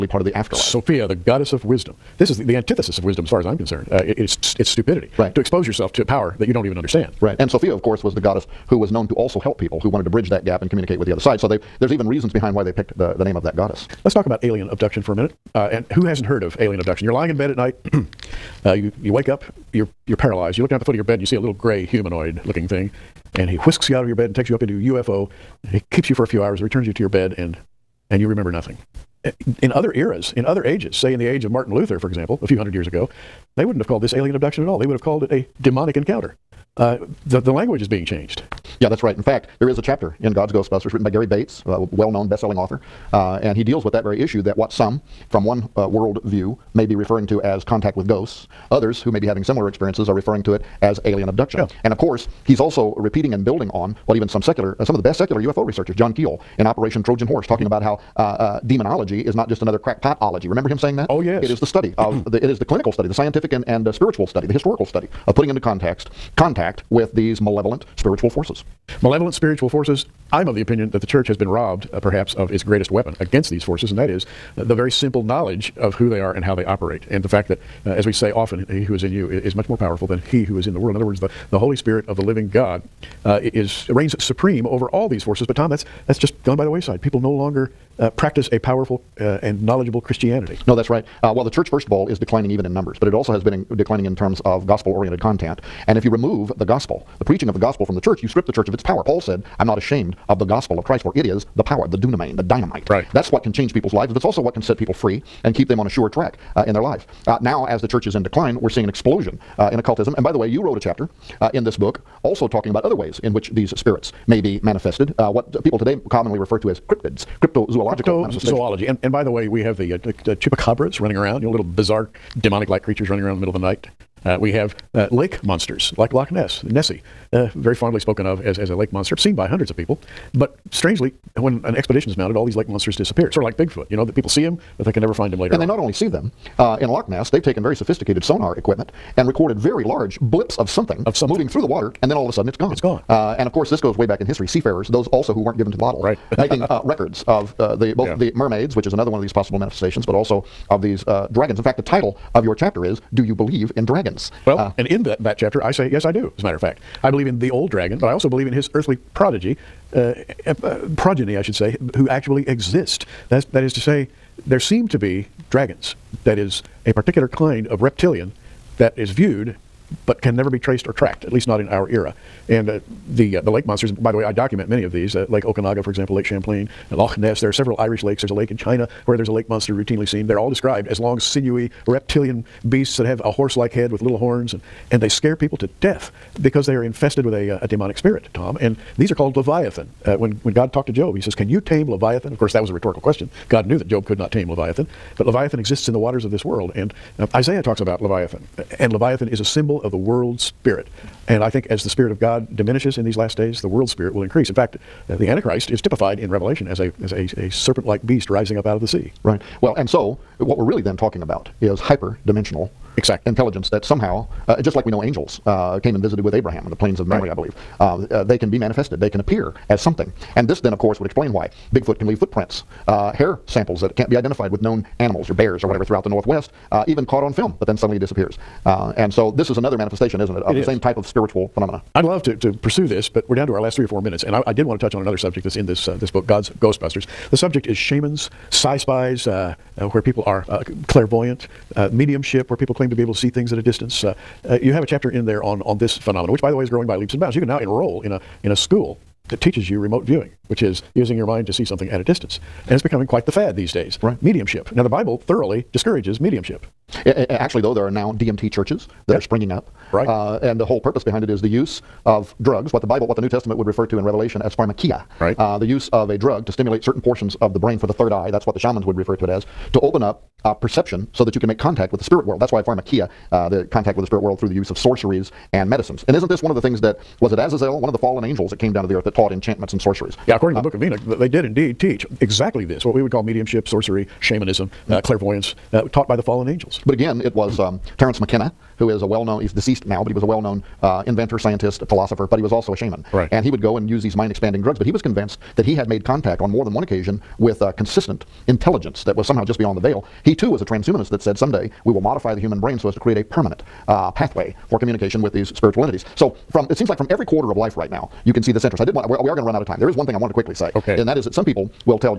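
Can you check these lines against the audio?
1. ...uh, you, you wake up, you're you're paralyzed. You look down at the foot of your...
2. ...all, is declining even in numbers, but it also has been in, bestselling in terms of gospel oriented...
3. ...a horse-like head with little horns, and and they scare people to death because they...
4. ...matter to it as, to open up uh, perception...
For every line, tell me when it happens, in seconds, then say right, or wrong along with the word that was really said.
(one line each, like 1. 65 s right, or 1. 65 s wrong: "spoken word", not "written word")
1. 18 s right
2. 91 s wrong: "declining", not "bestselling"
3. 183 s right
4. 268 s wrong: "refer", not "matter".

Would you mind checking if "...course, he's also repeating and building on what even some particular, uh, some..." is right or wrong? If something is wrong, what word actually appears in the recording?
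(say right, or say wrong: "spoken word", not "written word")
wrong: "secular", not "particular".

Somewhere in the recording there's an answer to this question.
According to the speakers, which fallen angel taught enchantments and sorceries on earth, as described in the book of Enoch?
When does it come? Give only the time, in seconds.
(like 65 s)
277 s.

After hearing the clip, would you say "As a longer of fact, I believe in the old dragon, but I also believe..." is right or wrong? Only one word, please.
wrong.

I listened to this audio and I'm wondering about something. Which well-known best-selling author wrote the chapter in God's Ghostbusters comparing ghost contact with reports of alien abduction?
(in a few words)
Gary Bates.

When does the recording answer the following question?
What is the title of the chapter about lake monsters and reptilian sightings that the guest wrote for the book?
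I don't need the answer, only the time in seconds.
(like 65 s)
153 s.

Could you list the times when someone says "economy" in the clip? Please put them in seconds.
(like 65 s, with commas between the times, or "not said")
not said.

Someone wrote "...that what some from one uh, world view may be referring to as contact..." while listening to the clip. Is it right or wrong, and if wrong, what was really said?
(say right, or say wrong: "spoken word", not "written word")
right.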